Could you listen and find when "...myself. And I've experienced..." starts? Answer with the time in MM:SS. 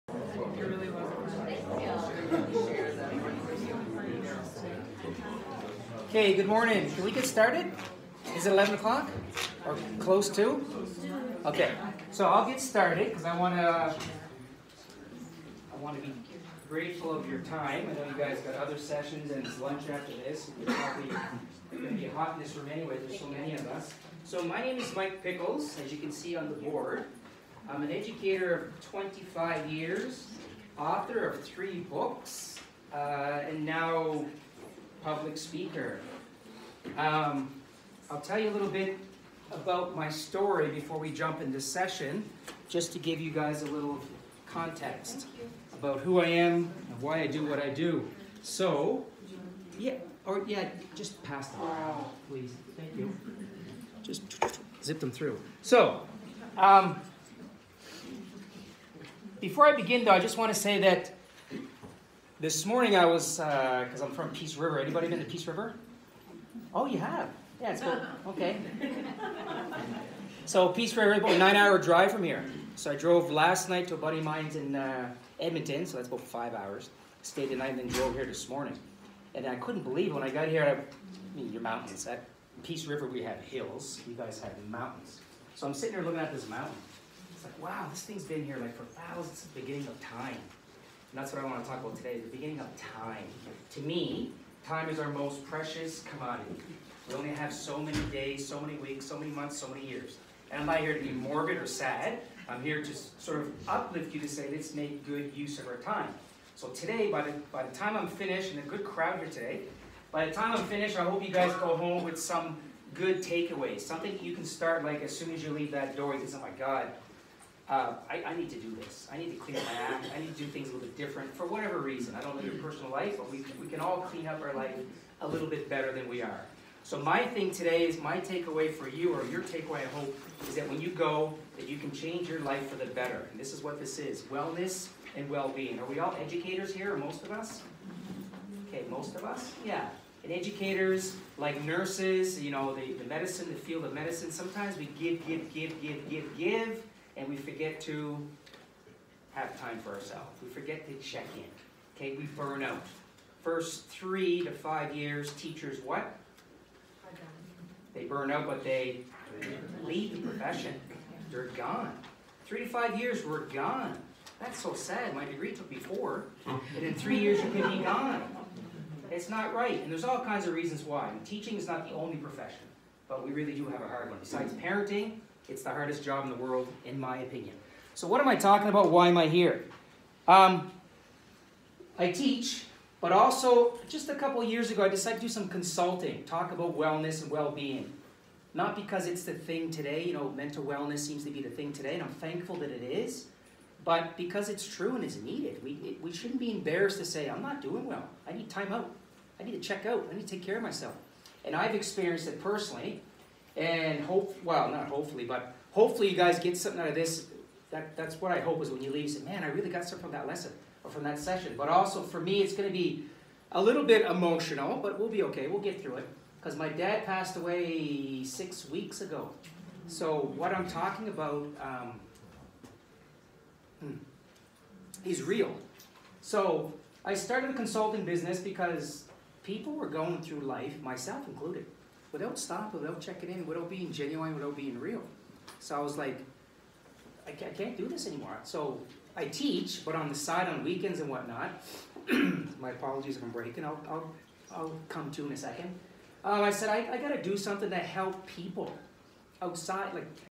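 03:20.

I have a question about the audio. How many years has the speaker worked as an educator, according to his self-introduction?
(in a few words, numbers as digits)
25.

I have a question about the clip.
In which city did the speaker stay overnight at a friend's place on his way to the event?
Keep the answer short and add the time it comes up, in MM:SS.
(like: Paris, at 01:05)
Edmonton, at 01:15.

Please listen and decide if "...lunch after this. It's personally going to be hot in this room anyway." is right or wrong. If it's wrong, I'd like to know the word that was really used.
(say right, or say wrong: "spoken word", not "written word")
wrong: "probably", not "personally".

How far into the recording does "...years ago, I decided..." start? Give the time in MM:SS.
03:04.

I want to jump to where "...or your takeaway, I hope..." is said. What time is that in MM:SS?
02:09.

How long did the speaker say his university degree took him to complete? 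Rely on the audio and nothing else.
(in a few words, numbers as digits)
4 years.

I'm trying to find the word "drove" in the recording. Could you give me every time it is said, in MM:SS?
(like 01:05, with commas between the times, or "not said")
01:12, 01:17.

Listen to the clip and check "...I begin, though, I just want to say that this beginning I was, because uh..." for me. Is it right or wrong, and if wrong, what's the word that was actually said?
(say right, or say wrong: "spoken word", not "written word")
wrong: "morning", not "beginning".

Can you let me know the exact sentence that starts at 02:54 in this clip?
Besides parenting, it's the hardest job in the world, in my opinion.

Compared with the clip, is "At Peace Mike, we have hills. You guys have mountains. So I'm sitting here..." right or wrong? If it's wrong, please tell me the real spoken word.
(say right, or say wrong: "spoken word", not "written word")
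wrong: "River", not "Mike".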